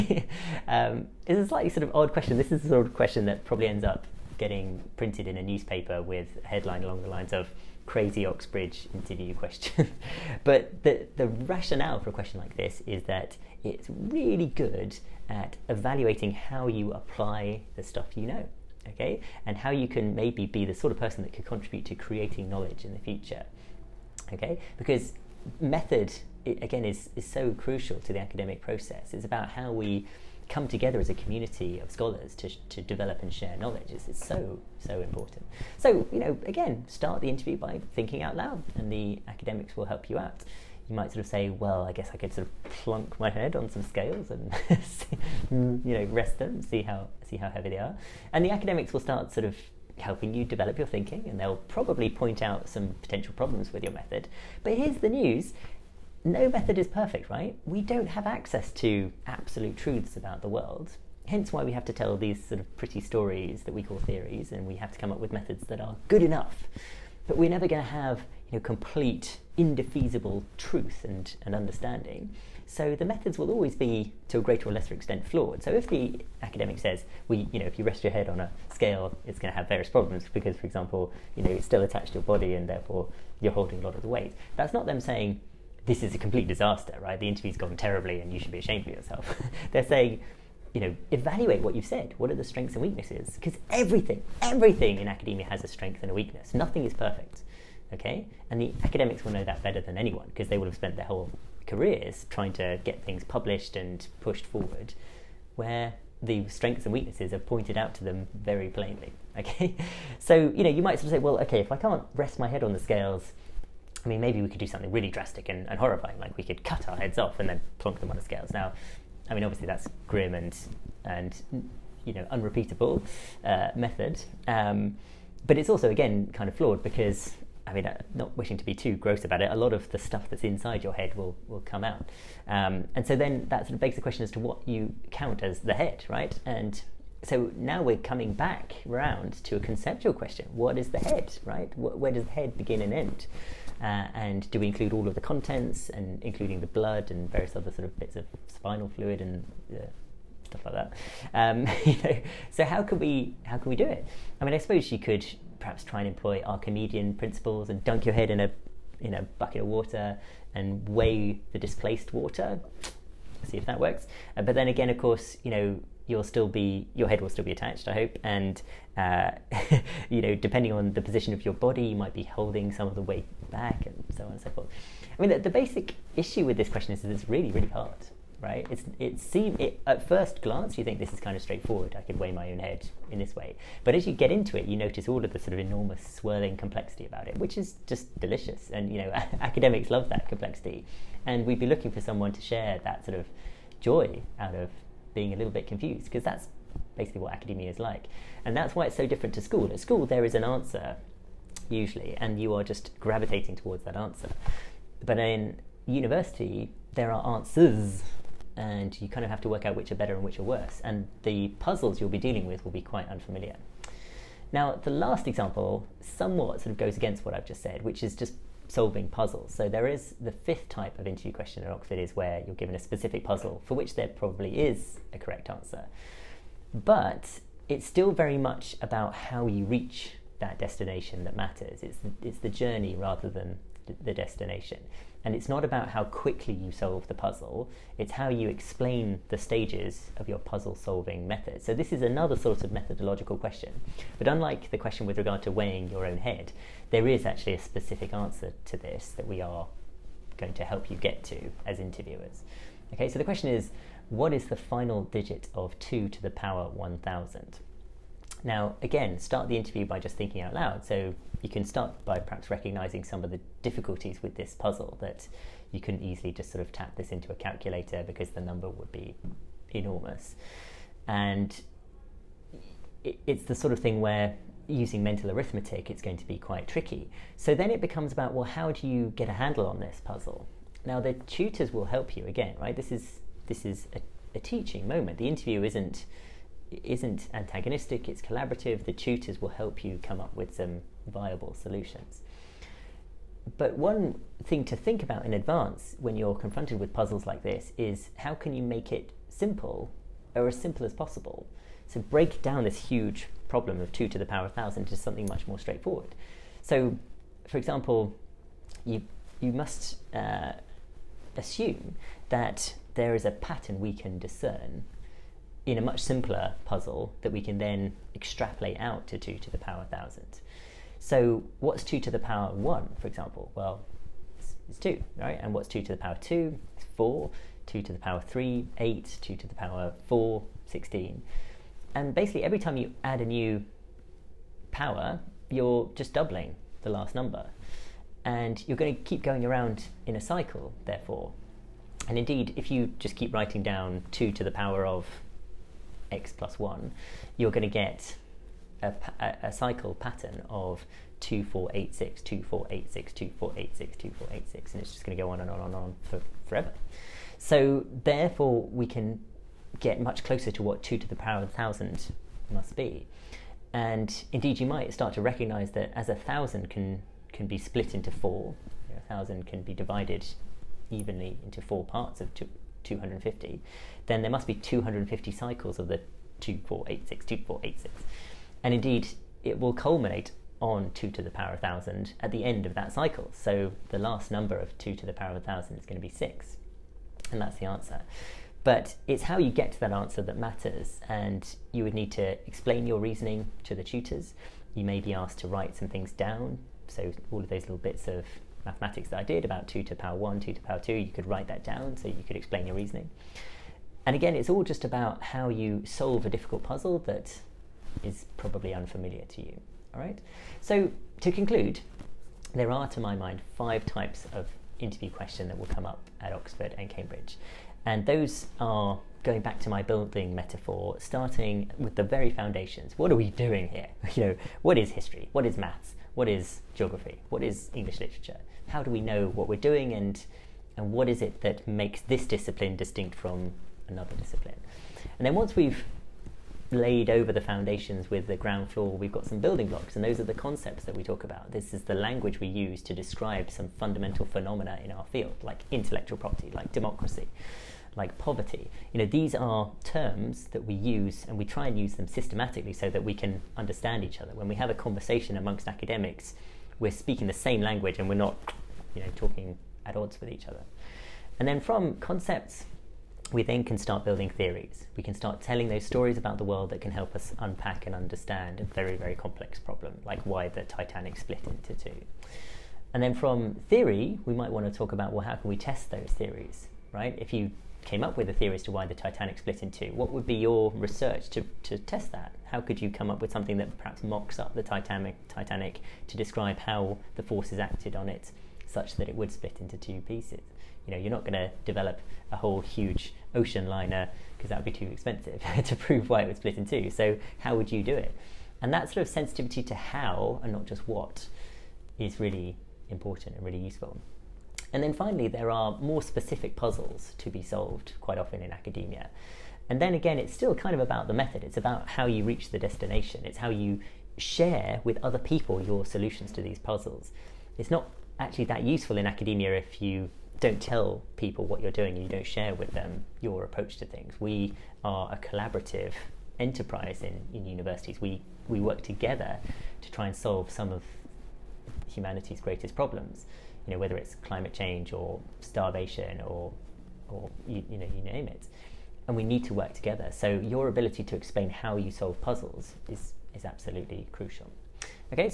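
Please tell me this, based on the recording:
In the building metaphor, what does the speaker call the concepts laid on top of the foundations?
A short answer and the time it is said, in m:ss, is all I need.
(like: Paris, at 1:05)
building blocks, at 7:19.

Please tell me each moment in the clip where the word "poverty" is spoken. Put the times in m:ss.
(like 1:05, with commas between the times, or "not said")
7:28.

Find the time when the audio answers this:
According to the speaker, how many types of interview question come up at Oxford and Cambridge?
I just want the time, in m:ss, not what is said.
6:53.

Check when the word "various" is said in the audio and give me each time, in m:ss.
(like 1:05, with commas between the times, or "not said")
1:19, 2:27.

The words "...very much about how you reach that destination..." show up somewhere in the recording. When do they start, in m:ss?
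3:48.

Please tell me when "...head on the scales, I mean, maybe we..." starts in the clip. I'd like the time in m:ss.
1:52.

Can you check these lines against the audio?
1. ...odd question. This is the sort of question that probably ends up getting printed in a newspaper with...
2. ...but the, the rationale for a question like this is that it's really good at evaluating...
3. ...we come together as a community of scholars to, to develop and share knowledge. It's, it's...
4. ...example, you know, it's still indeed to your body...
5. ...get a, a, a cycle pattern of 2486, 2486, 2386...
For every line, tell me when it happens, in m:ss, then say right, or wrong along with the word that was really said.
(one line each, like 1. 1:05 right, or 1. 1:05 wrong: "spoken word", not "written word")
1. 0:01 right
2. 0:10 right
3. 0:29 right
4. 1:20 wrong: "attached", not "indeed"
5. 5:47 wrong: "2486", not "2386".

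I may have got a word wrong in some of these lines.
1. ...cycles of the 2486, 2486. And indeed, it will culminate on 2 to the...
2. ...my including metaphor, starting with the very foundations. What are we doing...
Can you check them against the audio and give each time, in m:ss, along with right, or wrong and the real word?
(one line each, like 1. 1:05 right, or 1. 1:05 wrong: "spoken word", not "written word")
1. 6:15 right
2. 6:59 wrong: "building", not "including".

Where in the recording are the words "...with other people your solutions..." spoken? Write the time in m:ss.
8:34.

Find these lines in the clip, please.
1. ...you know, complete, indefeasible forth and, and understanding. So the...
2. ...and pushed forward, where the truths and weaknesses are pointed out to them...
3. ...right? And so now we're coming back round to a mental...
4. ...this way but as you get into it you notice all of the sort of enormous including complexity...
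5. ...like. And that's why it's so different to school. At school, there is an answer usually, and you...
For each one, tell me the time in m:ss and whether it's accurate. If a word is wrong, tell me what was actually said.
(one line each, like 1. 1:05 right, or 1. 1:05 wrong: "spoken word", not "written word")
1. 1:08 wrong: "truth", not "forth"
2. 1:43 wrong: "strengths", not "truths"
3. 2:16 wrong: "conceptual", not "mental"
4. 3:03 wrong: "swirling", not "including"
5. 3:17 right.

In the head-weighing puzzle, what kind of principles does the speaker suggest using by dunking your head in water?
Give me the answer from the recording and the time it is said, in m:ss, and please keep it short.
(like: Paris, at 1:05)
Archimedean, at 2:36.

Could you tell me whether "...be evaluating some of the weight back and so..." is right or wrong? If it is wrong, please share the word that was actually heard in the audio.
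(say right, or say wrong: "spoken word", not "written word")
wrong: "holding", not "evaluating".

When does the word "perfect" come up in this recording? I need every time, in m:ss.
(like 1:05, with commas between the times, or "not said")
0:56, 1:36.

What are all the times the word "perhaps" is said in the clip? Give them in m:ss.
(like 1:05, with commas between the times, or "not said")
2:35, 4:22, 8:03.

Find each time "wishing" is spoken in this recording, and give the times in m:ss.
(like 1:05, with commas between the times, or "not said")
2:08.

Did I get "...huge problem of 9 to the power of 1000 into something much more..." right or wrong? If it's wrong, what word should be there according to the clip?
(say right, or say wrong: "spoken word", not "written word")
wrong: "2", not "9".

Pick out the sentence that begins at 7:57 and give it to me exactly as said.
If you came up with a theory as to why the Titanic split in two.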